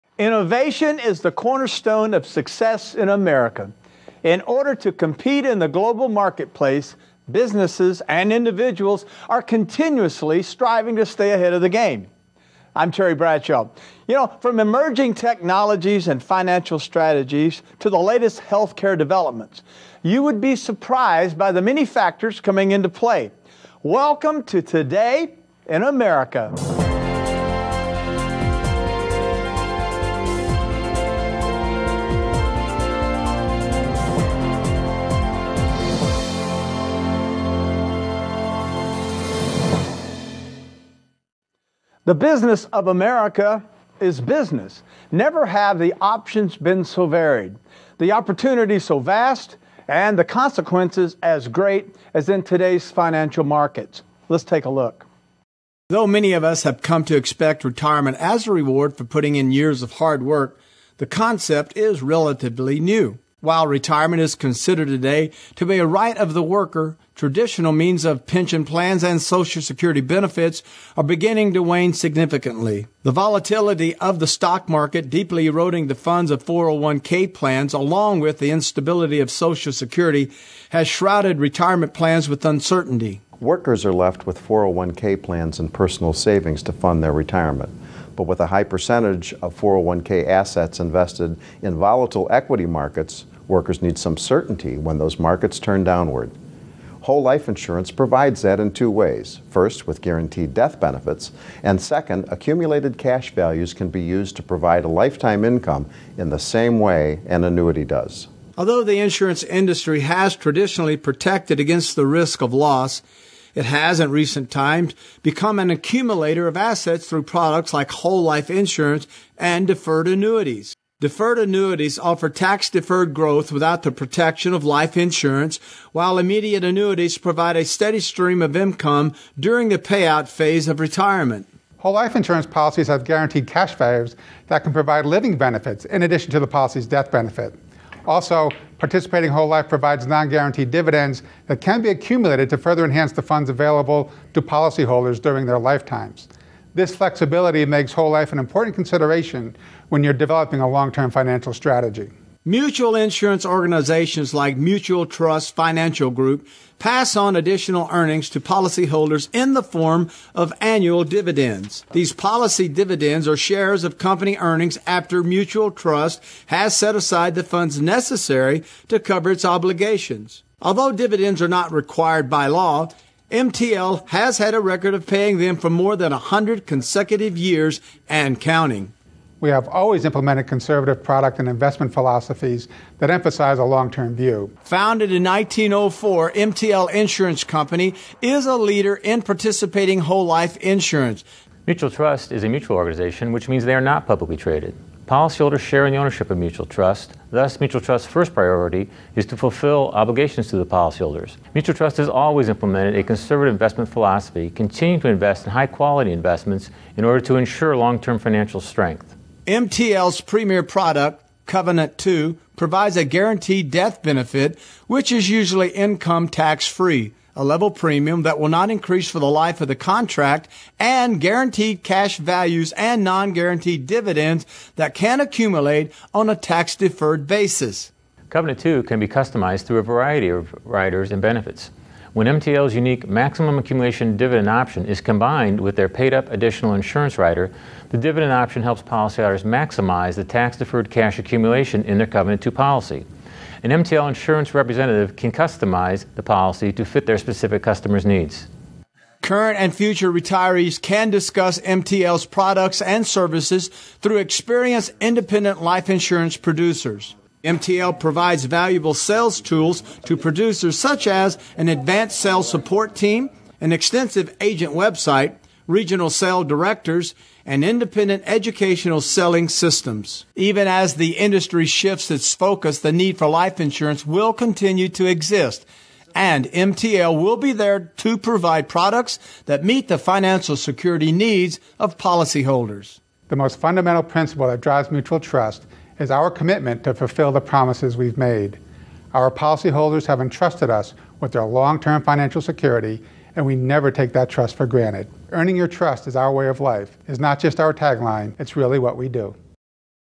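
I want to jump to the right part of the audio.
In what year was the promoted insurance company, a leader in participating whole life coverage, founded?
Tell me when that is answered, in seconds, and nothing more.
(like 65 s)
185 s.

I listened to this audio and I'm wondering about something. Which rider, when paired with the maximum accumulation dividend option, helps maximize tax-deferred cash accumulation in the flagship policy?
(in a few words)
paid up additional insurance rider.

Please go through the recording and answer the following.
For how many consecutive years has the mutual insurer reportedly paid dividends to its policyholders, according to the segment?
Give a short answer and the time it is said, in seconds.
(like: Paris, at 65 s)
more than 100, at 175 s.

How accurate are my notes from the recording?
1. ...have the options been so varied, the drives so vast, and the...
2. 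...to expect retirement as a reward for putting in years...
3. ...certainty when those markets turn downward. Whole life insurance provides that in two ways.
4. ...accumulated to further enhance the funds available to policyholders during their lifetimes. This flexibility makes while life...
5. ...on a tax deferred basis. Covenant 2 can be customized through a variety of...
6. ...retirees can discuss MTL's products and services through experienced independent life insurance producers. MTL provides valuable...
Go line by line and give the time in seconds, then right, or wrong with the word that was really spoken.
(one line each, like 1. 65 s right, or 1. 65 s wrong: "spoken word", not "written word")
1. 45 s wrong: "opportunities", not "drives"
2. 57 s right
3. 94 s right
4. 141 s wrong: "whole", not "while"
5. 226 s right
6. 250 s right.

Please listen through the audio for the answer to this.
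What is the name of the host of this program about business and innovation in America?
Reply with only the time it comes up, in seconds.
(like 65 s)
12 s.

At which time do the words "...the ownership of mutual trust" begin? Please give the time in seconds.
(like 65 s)
195 s.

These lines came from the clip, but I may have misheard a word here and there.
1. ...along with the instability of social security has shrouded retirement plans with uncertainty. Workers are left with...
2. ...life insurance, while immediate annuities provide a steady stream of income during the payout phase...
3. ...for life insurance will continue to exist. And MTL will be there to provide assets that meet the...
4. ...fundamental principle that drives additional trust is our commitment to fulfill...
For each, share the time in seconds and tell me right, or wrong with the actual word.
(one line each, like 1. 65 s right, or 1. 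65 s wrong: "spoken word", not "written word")
1. 77 s right
2. 124 s right
3. 273 s wrong: "products", not "assets"
4. 283 s wrong: "mutual", not "additional".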